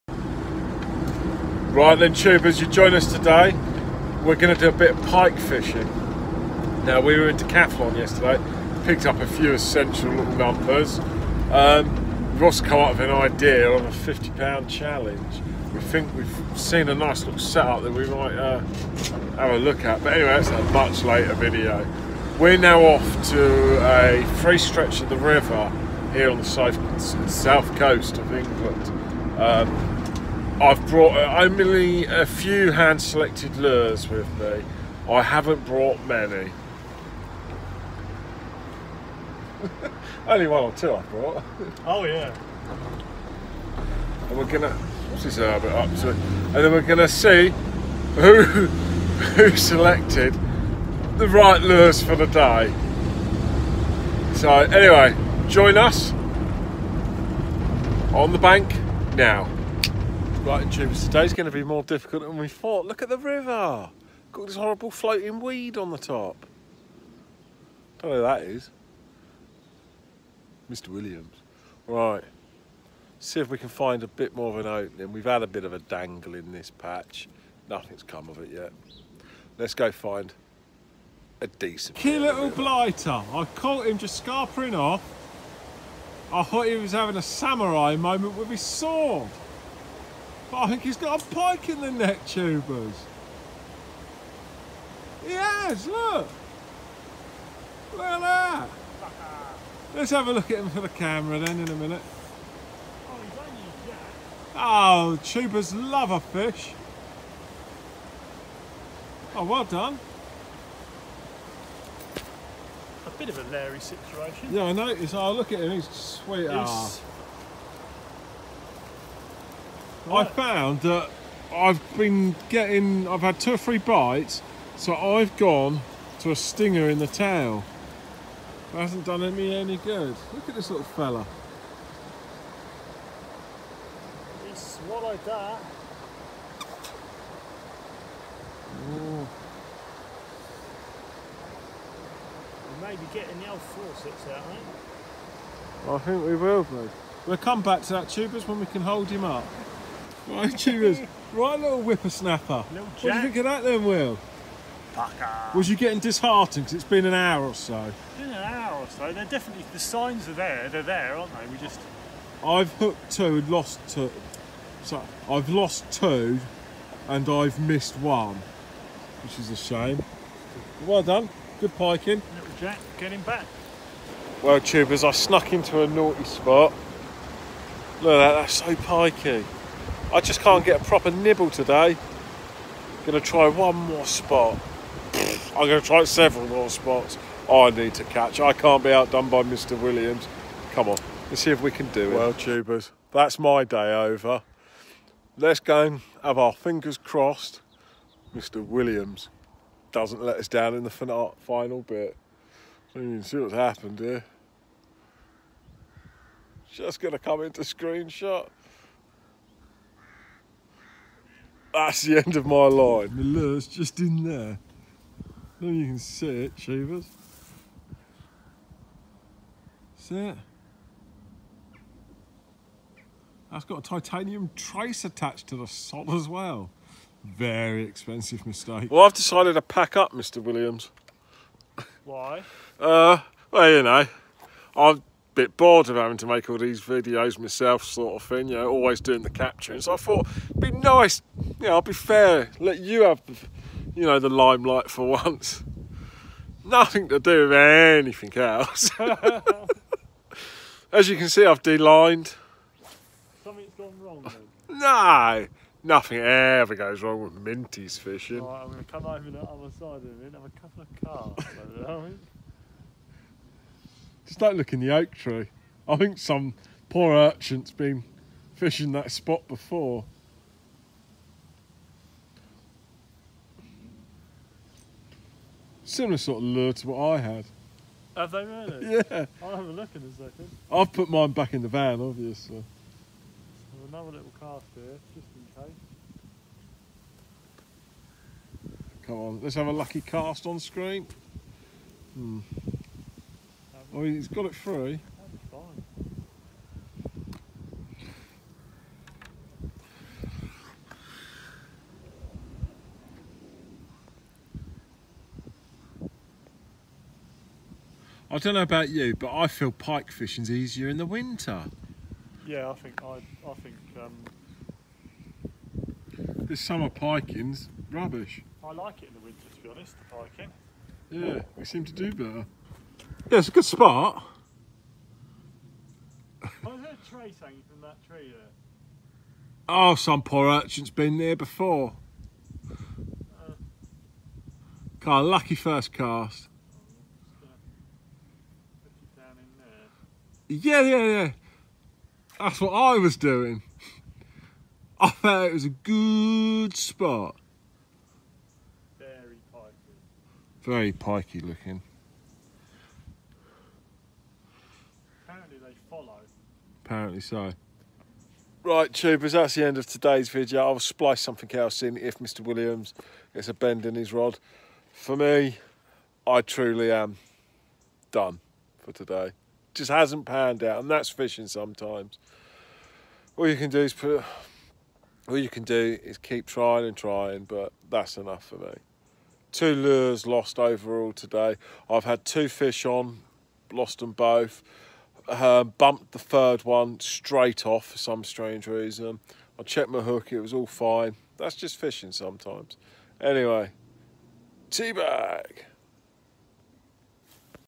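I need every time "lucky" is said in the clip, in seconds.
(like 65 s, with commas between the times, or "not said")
289 s, 335 s.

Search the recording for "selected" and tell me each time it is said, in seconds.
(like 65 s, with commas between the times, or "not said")
33 s, 49 s.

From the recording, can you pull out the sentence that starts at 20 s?
But anyway, that's a much later video.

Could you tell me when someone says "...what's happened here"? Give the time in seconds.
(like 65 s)
203 s.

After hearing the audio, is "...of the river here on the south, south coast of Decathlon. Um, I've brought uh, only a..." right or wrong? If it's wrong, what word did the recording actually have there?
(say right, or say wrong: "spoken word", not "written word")
wrong: "England", not "Decathlon".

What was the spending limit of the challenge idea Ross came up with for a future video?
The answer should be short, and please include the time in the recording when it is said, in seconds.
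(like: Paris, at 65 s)
50 pound, at 13 s.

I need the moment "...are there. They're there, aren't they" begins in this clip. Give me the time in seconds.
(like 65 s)
160 s.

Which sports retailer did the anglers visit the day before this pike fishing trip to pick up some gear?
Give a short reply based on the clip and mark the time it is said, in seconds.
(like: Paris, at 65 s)
Decathlon, at 7 s.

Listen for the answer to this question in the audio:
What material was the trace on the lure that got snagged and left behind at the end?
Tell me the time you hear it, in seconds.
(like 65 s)
223 s.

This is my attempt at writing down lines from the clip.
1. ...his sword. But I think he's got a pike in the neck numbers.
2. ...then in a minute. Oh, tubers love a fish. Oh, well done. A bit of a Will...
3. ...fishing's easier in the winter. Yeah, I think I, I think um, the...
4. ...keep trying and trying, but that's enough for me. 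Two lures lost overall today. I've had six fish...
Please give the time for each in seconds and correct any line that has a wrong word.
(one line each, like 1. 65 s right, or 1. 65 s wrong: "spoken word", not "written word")
1. 88 s wrong: "tubers", not "numbers"
2. 101 s wrong: "Larry", not "Will"
3. 310 s right
4. 376 s wrong: "two", not "six".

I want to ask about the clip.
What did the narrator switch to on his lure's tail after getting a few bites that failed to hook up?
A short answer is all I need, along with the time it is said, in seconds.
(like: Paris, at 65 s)
a stinger, at 126 s.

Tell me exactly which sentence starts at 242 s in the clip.
Let you have, you know, the limelight for once.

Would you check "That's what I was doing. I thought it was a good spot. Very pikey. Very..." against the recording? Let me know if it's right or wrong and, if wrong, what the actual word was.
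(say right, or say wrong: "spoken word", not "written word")
right.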